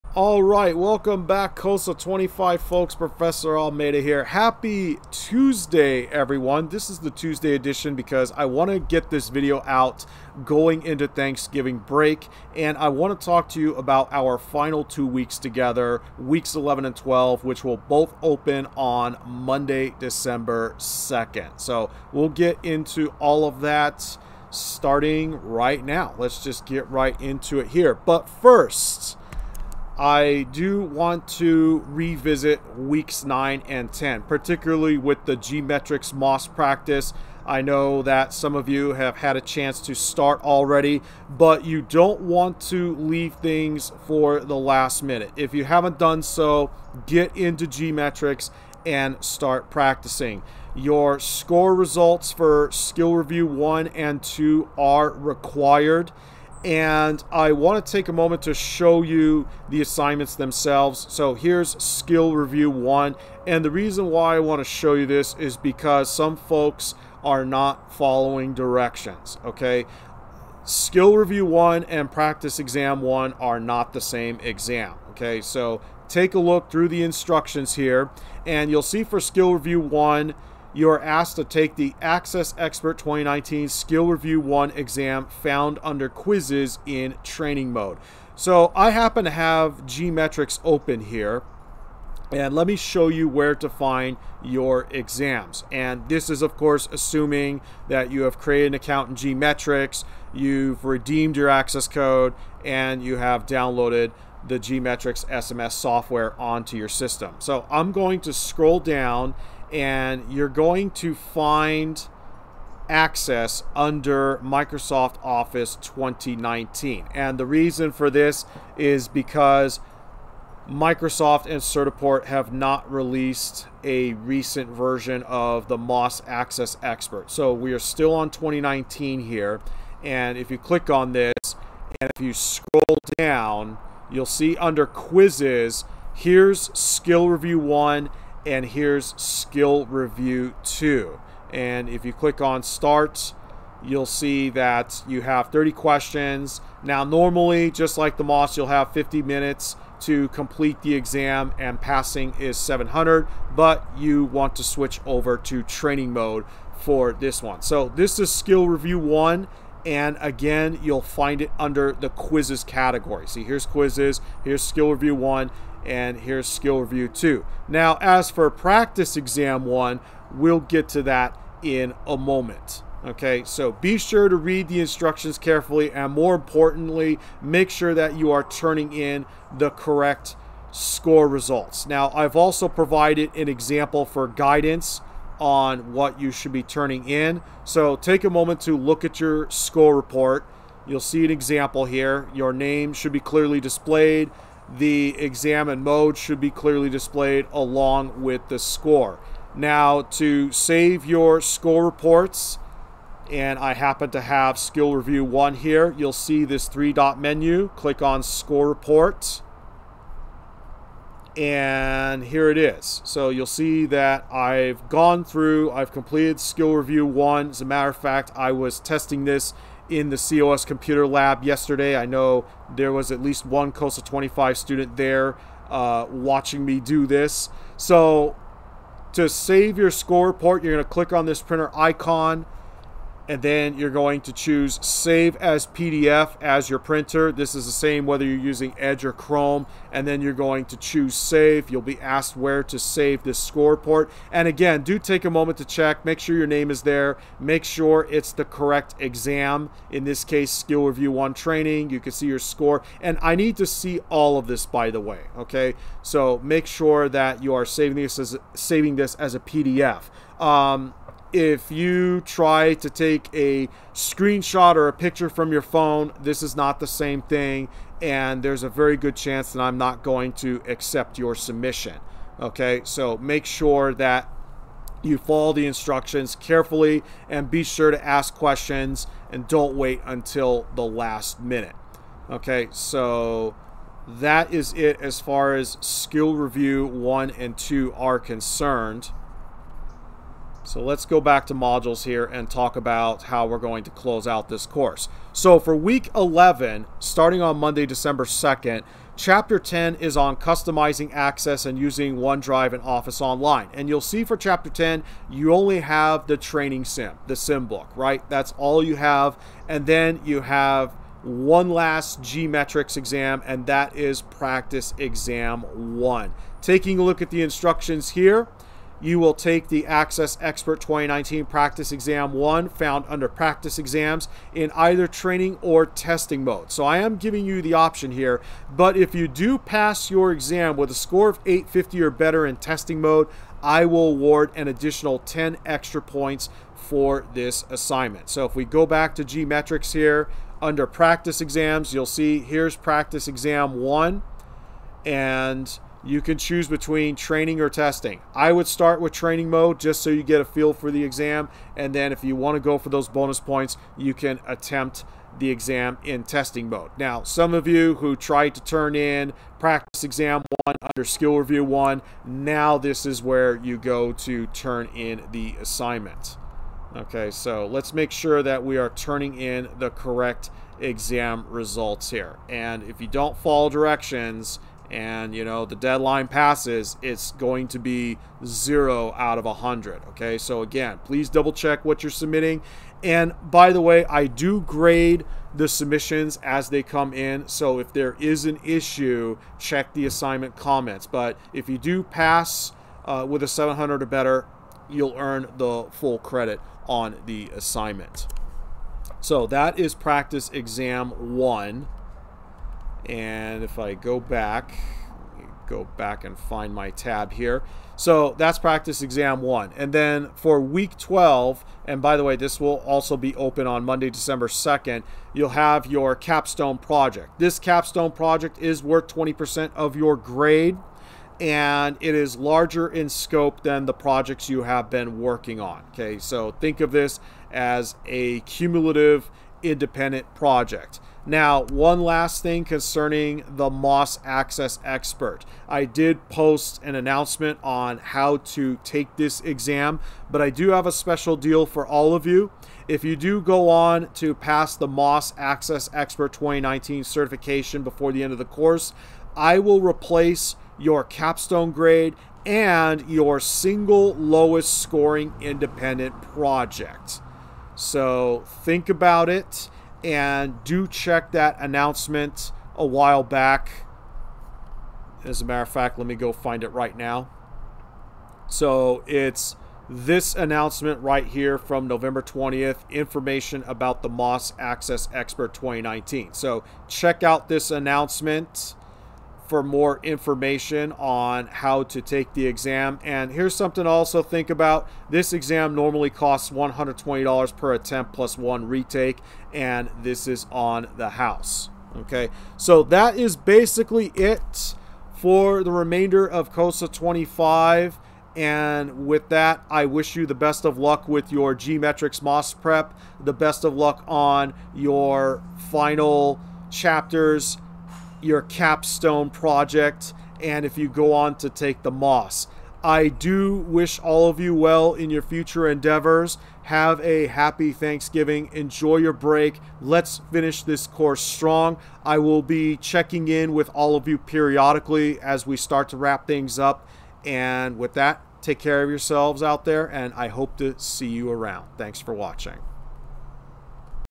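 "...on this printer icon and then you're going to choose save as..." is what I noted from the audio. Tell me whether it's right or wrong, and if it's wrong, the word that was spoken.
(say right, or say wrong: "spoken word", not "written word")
right.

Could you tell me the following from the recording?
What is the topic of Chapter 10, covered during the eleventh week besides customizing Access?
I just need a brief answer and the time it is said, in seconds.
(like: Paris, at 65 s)
OneDrive and Office Online, at 301 s.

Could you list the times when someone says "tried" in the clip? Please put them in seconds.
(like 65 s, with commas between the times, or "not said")
358 s.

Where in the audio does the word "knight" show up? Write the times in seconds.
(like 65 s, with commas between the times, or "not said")
not said.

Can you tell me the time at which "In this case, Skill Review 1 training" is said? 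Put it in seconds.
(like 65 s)
249 s.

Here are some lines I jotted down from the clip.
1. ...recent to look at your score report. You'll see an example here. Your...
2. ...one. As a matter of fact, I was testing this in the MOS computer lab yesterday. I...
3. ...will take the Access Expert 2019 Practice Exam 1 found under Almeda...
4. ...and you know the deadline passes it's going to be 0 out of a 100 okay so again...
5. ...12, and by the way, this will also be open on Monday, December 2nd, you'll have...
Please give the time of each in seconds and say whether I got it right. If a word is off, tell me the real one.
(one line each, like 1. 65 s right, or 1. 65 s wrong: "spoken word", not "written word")
1. 188 s wrong: "moment", not "recent"
2. 217 s wrong: "COS", not "MOS"
3. 319 s wrong: "Practice", not "Almeda"
4. 374 s right
5. 410 s right.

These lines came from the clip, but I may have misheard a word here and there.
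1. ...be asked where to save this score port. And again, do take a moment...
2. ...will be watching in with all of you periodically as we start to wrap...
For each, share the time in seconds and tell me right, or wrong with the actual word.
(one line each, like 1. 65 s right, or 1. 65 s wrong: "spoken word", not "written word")
1. 241 s right
2. 522 s wrong: "checking", not "watching".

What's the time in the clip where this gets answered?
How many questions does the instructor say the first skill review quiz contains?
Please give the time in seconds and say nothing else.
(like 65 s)
145 s.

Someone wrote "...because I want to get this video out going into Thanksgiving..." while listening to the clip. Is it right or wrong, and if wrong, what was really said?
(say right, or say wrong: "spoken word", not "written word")
right.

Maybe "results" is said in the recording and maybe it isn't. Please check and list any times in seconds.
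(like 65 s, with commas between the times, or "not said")
51 s, 181 s, 371 s.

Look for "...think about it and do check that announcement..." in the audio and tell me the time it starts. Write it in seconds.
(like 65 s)
458 s.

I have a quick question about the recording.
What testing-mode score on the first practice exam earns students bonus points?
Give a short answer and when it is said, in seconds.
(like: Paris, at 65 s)
850, at 331 s.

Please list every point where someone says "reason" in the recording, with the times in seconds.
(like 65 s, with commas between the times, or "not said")
63 s, 117 s.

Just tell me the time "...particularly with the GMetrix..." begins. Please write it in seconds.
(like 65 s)
34 s.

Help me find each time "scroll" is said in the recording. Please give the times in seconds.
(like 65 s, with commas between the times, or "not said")
108 s, 132 s.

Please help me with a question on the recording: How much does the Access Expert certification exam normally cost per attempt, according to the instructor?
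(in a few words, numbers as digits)
$120.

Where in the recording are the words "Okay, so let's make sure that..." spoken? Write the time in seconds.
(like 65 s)
366 s.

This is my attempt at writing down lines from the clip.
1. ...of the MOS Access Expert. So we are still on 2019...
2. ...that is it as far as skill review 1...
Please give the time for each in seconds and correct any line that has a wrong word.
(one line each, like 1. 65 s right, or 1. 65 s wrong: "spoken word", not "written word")
1. 125 s right
2. 284 s right.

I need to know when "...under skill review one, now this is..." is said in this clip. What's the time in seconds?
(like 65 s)
360 s.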